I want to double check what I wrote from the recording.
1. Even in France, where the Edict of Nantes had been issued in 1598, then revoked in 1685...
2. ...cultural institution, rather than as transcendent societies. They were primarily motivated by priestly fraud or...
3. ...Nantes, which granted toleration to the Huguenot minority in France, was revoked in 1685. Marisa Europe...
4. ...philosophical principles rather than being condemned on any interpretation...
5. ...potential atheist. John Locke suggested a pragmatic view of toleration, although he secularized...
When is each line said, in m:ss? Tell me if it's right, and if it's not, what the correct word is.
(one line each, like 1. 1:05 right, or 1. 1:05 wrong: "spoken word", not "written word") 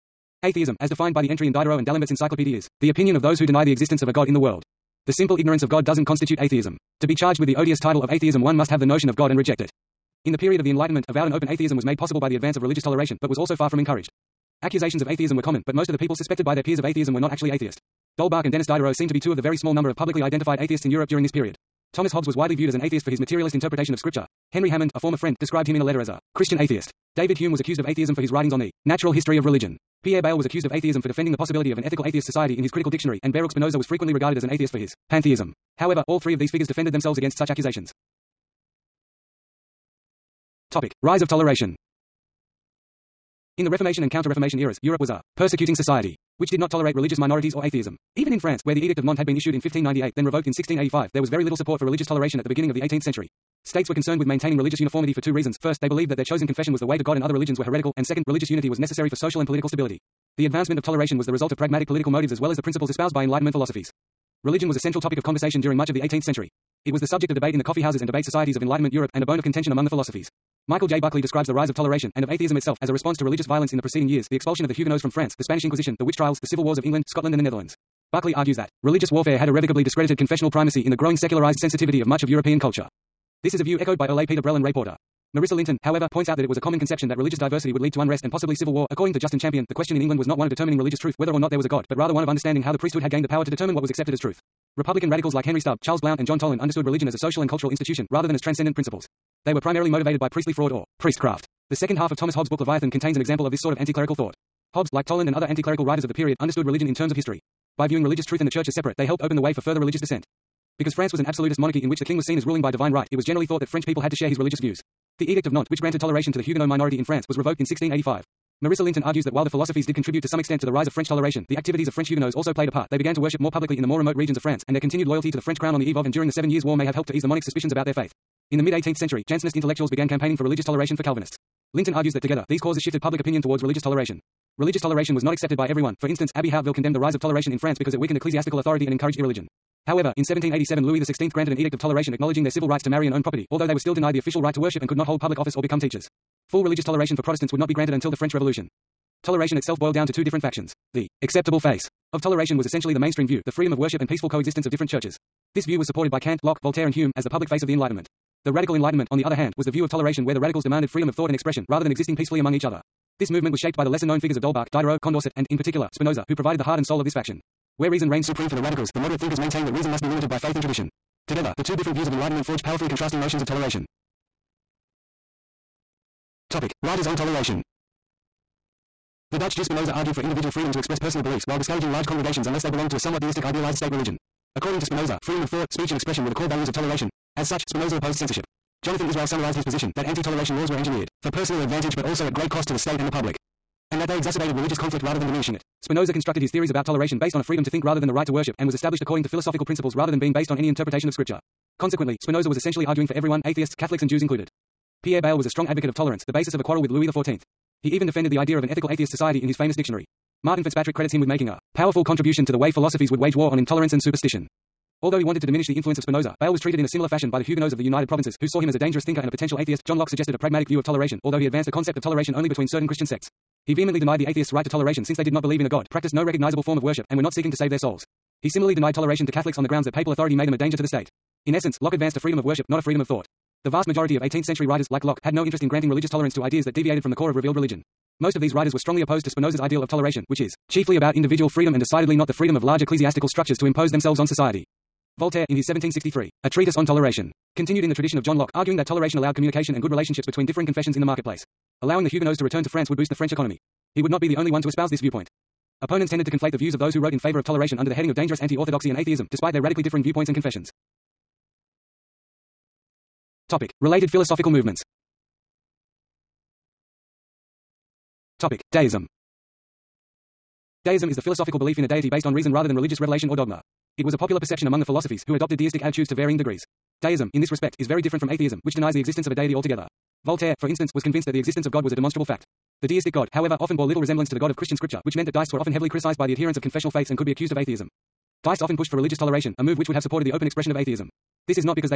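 1. 0:48 right
2. 1:37 wrong: "principles", not "societies"
3. 1:55 wrong: "Linton", not "Europe"
4. 3:19 wrong: "based", not "condemned"
5. 3:39 wrong: "advanced", not "secularized".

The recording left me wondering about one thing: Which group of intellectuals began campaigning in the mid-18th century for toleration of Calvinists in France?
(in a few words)
Jansenist intellectuals.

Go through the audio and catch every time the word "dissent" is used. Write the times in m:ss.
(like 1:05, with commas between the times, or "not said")
1:50.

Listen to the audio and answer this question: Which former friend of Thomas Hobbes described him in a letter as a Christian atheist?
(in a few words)
Henry Hammond.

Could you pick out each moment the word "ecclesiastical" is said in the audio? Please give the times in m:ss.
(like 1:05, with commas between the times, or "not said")
2:18, 4:02.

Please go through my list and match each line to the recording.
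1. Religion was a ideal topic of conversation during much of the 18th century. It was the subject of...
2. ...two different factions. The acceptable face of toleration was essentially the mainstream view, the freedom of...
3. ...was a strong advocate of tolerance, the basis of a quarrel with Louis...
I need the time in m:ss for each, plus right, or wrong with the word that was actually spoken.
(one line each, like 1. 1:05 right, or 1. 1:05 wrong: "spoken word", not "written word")
1. 1:04 wrong: "central", not "ideal"
2. 2:30 right
3. 3:25 right.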